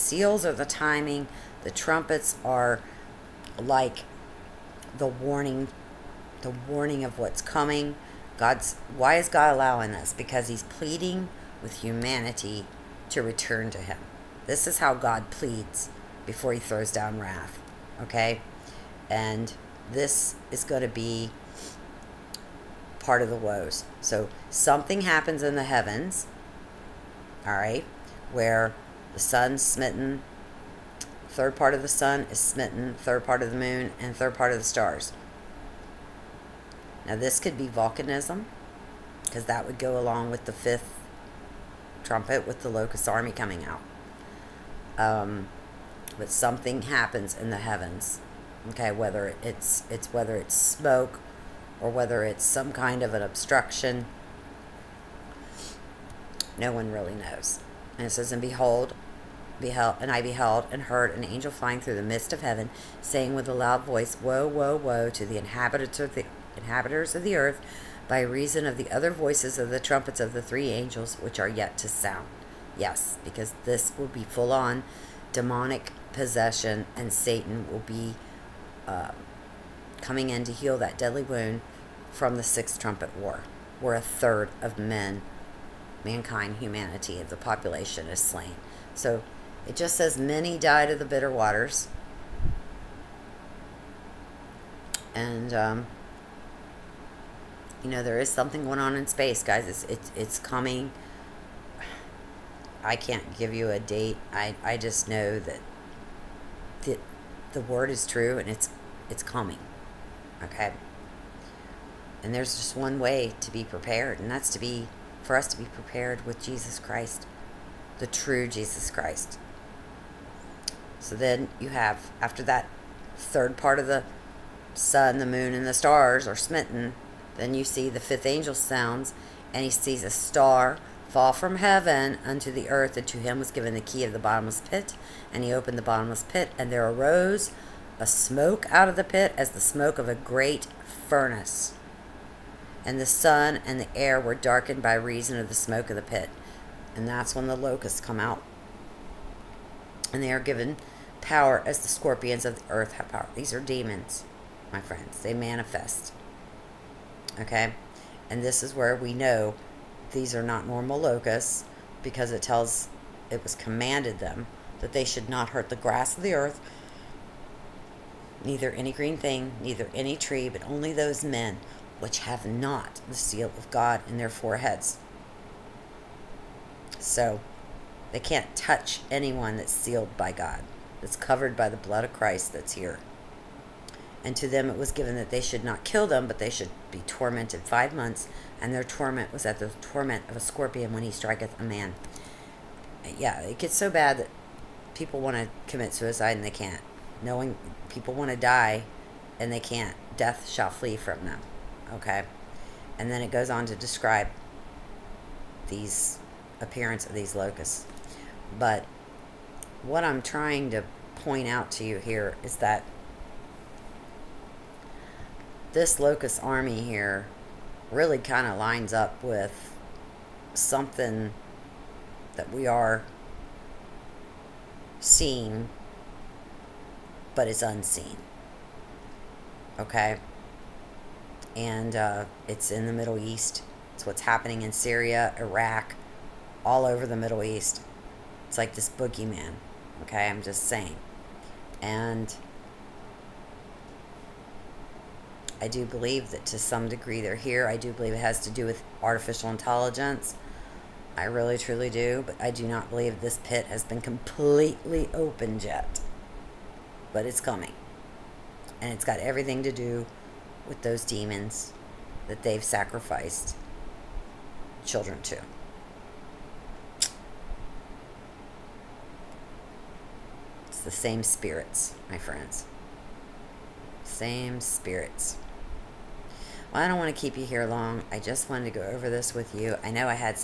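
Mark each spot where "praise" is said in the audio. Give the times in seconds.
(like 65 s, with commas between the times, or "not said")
not said.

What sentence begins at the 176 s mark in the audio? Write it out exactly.
So they can't touch anyone that's sealed by God, that's covered by the blood of Christ that's here.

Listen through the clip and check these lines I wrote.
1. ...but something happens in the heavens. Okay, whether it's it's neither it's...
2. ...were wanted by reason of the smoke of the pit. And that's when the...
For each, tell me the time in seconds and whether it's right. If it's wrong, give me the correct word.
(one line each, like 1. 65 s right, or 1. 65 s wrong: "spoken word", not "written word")
1. 46 s wrong: "whether", not "neither"
2. 144 s wrong: "darkened", not "wanted".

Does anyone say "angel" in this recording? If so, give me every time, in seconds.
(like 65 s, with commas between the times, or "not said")
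61 s, 70 s, 128 s.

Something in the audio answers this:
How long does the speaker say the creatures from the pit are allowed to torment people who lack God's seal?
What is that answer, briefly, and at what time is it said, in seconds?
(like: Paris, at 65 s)
5 months, at 187 s.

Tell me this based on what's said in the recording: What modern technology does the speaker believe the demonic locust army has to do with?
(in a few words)
Artificial intelligence.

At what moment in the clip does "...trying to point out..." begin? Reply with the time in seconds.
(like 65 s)
210 s.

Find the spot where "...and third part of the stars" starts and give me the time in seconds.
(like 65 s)
33 s.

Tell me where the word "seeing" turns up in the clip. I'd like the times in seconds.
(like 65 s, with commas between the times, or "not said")
225 s.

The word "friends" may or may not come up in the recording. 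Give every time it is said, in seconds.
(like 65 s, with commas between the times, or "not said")
154 s, 272 s.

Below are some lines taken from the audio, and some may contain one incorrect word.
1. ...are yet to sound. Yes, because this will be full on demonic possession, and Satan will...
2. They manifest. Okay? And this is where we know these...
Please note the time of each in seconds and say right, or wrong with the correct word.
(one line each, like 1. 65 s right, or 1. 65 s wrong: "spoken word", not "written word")
1. 71 s right
2. 155 s right.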